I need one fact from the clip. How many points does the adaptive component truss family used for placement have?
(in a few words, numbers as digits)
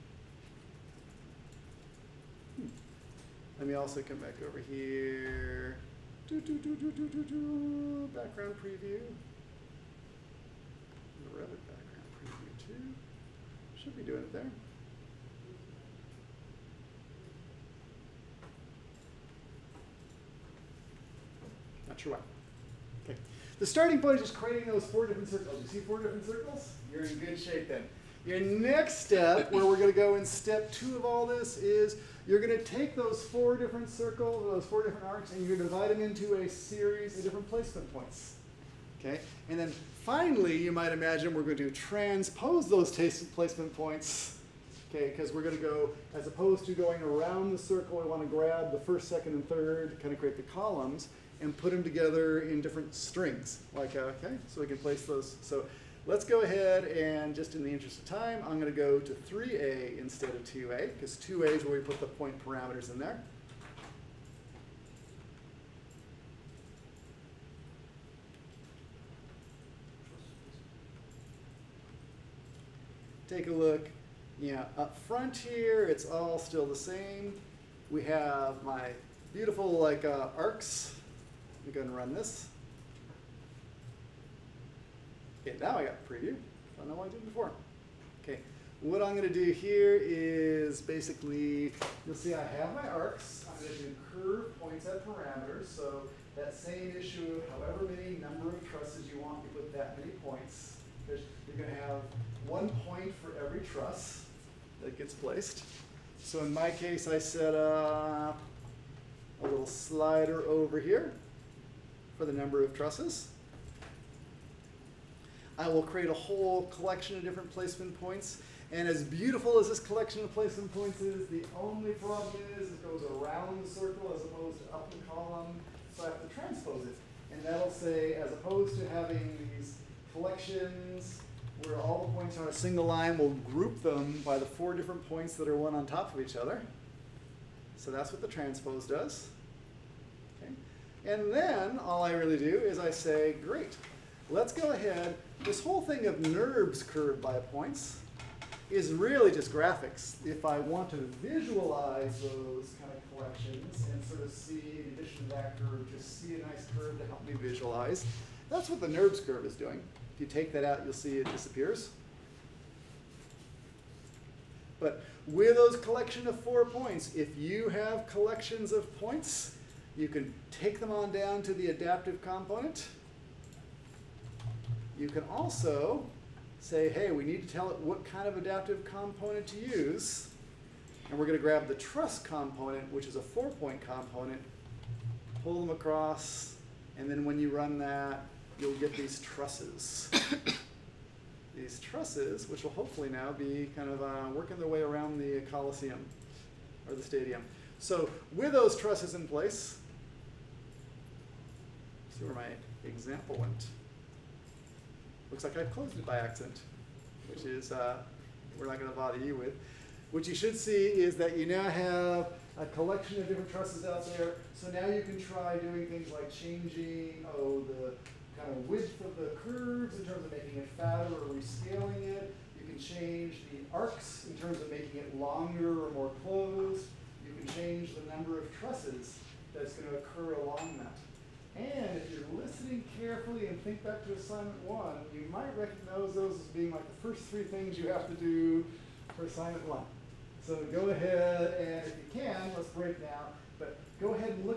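4.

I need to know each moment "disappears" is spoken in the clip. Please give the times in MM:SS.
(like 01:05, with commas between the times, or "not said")
02:41.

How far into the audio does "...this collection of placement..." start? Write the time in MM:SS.
01:59.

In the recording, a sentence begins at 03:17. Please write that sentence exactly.
So with those trusses in place, see where my example went.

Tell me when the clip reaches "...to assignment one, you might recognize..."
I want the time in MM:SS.
03:54.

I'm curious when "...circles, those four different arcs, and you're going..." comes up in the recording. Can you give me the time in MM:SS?
00:33.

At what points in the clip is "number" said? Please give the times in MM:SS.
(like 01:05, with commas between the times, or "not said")
01:38, 01:52, 03:48.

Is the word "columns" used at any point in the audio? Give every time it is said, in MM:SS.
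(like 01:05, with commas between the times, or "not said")
00:50, 02:05.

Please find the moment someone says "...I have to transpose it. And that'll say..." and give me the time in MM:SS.
02:06.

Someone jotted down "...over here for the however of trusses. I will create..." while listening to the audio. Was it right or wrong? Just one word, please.
wrong.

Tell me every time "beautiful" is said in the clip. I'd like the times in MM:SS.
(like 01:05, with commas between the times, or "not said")
01:19, 01:59.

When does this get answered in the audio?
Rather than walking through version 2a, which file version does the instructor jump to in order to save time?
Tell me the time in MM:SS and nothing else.
00:59.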